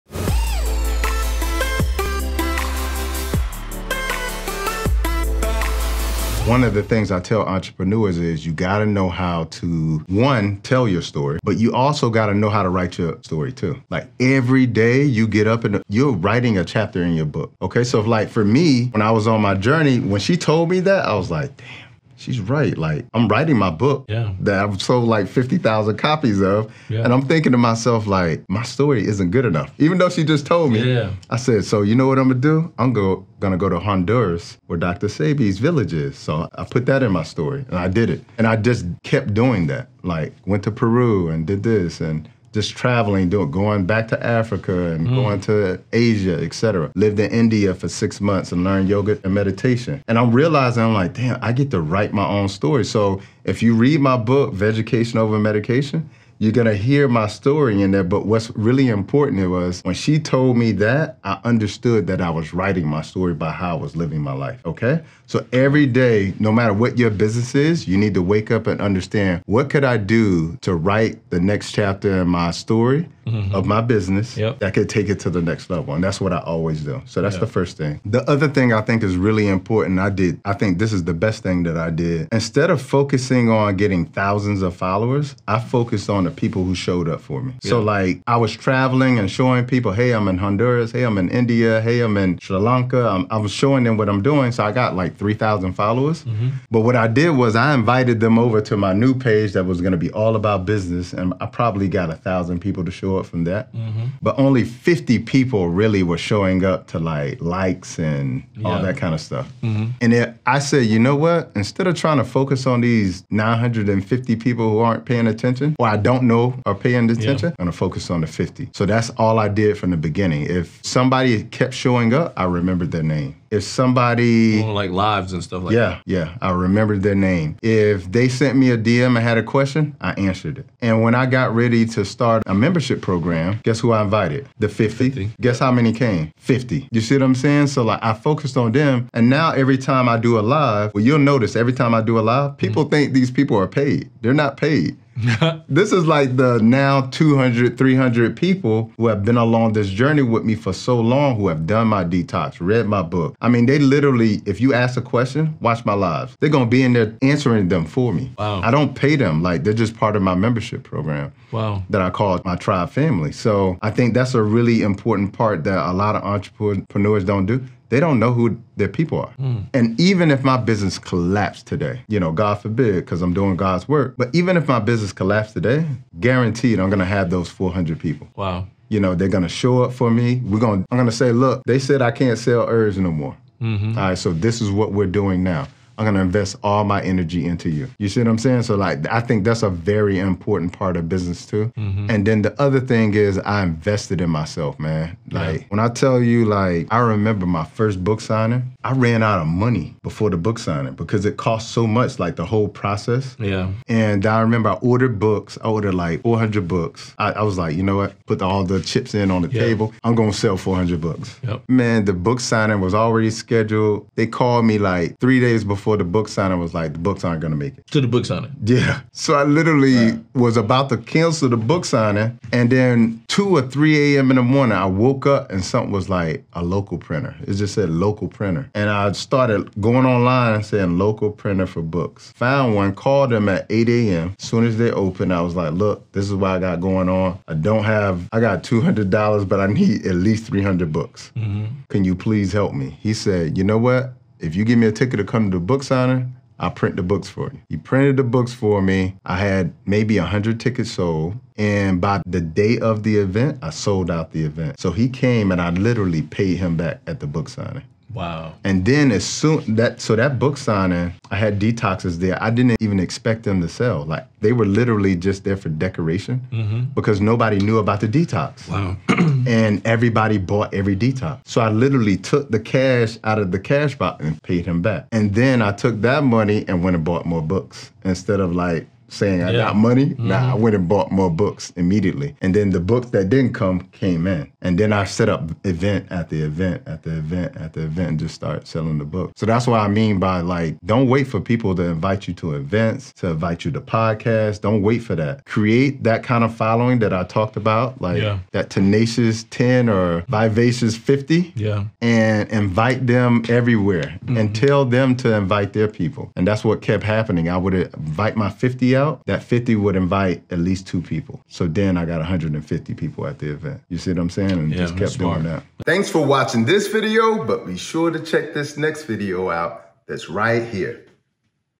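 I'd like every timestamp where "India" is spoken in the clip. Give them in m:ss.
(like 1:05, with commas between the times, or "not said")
0:47, 1:31.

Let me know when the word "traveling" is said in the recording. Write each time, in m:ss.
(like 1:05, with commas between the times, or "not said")
0:42, 1:28.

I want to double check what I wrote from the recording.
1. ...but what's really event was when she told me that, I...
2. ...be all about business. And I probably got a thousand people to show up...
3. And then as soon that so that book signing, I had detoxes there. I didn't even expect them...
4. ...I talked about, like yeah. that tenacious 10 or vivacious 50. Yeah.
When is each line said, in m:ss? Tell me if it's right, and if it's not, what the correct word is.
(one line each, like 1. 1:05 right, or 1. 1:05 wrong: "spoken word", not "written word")
1. 0:58 wrong: "important", not "event"
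2. 1:39 right
3. 4:18 right
4. 4:57 right.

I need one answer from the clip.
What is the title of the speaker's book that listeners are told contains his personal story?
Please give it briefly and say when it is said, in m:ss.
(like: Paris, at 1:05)
Vegetation Over Medication, at 0:54.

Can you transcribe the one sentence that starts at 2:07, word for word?
If they sent me a DM and had a question, I answered it.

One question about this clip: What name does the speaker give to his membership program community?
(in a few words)
tribe family.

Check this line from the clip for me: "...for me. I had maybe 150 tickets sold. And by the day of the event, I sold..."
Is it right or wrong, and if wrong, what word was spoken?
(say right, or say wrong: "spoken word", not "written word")
wrong: "100", not "150".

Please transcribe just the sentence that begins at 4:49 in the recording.
So that's what I mean by like, don't wait for people to invite you to events, to invite you to podcasts.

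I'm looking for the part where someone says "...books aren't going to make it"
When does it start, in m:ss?
3:36.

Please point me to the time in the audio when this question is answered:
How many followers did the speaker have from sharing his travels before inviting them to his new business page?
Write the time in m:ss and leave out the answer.
1:35.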